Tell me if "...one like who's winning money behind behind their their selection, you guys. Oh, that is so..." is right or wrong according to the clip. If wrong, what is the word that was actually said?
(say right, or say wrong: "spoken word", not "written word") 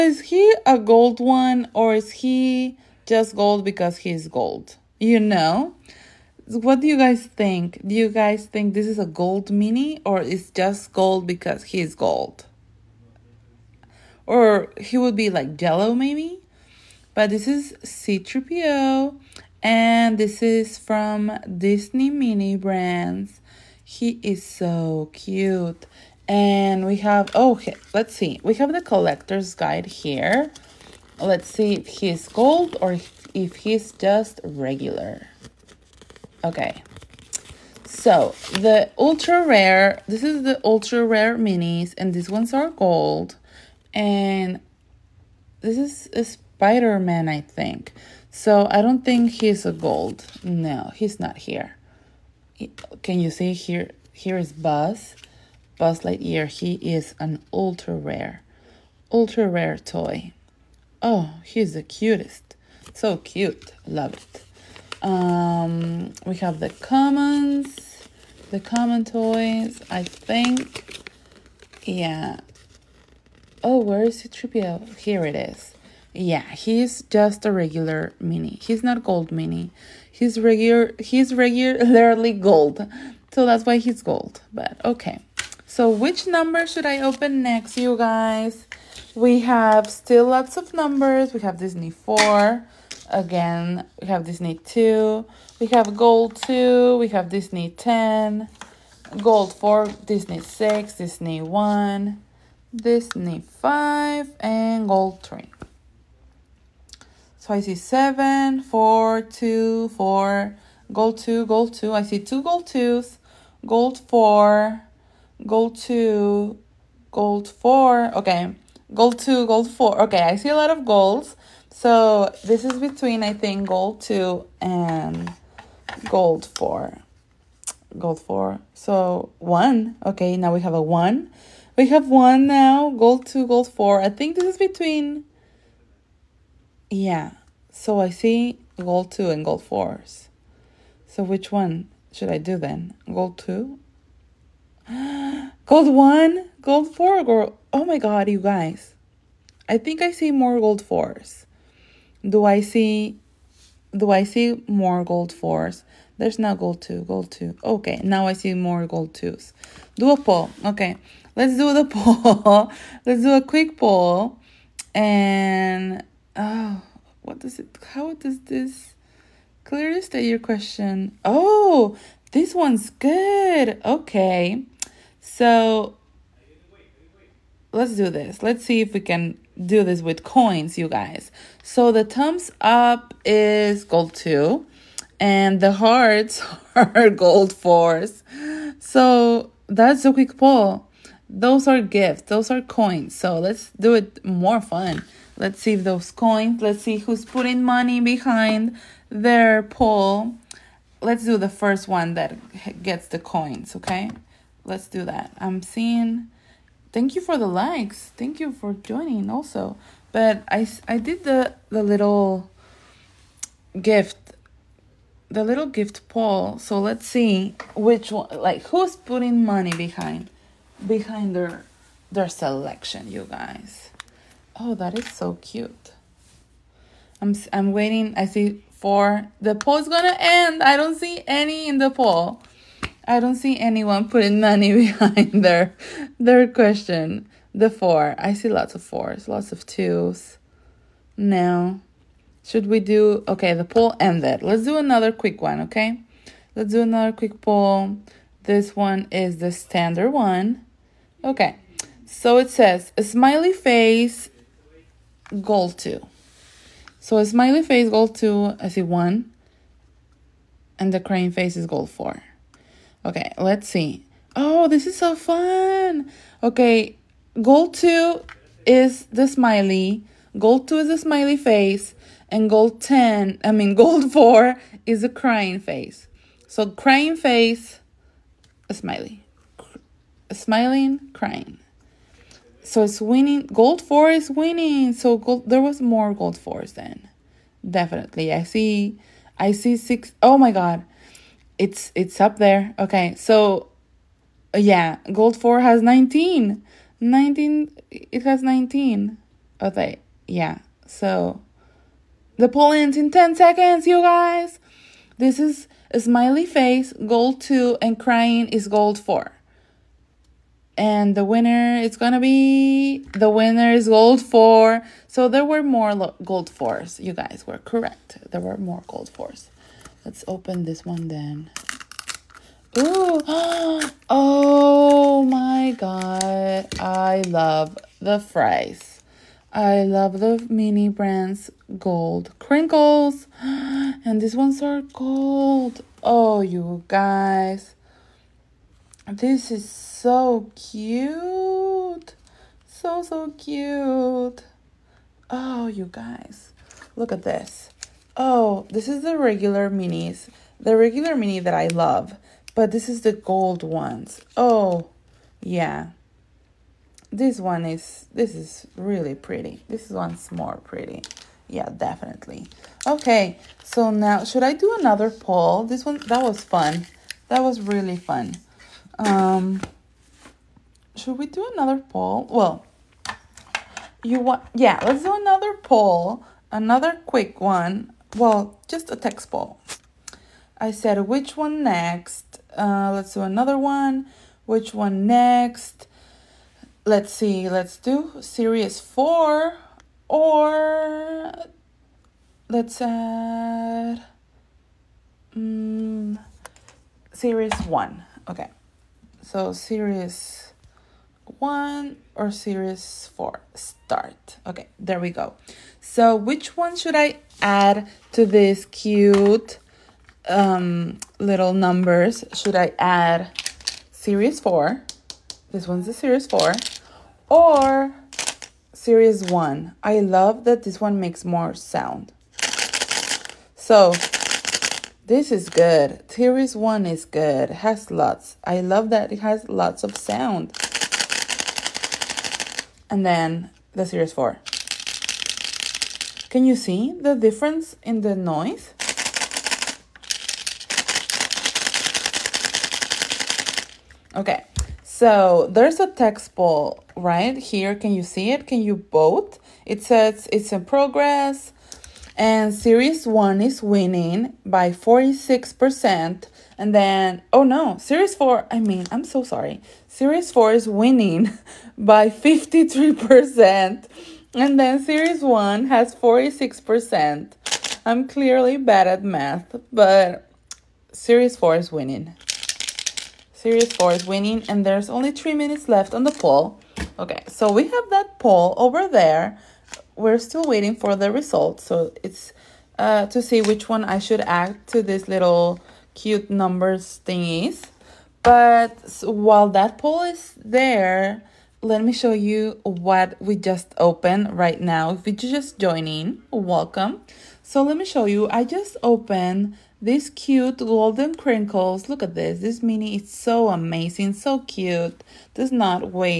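wrong: "putting", not "winning".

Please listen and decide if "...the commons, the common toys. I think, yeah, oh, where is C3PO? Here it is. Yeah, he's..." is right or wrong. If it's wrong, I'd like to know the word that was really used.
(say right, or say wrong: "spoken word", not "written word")
right.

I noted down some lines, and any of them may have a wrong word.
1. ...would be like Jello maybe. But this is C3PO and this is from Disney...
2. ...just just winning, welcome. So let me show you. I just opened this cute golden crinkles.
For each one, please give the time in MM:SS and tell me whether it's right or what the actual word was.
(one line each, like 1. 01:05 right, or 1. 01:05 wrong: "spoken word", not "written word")
1. 00:14 right
2. 08:15 wrong: "joining", not "winning".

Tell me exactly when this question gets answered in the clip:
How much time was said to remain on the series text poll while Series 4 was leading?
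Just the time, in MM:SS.
07:55.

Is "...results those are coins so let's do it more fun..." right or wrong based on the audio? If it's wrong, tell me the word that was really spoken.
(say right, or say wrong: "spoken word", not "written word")
wrong: "gifts", not "results".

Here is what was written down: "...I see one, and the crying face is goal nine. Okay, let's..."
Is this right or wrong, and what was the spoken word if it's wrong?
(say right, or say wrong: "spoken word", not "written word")
wrong: "four", not "nine".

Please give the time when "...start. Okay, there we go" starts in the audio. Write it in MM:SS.
06:43.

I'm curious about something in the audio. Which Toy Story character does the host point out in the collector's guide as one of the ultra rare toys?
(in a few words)
Buzz Lightyear.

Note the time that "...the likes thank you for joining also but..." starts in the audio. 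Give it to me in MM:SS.
03:27.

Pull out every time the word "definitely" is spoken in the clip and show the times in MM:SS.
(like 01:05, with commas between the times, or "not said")
04:47, 06:01.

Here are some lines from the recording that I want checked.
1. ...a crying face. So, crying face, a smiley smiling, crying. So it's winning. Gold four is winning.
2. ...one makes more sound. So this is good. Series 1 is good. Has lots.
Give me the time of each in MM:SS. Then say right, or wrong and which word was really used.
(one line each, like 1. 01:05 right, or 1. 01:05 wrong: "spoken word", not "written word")
1. 04:35 right
2. 07:00 right.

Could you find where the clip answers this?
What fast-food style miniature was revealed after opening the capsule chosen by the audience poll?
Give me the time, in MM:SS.
05:31.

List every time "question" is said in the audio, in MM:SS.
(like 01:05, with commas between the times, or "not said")
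02:50, 03:56.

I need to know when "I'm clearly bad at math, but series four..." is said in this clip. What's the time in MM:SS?
07:47.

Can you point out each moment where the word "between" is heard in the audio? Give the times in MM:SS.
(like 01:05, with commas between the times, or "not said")
02:02, 02:14.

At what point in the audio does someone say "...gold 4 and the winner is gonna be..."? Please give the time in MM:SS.
05:08.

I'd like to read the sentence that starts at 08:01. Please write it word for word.
So it's uh, to see which one I should add to this little cute numbers thingies.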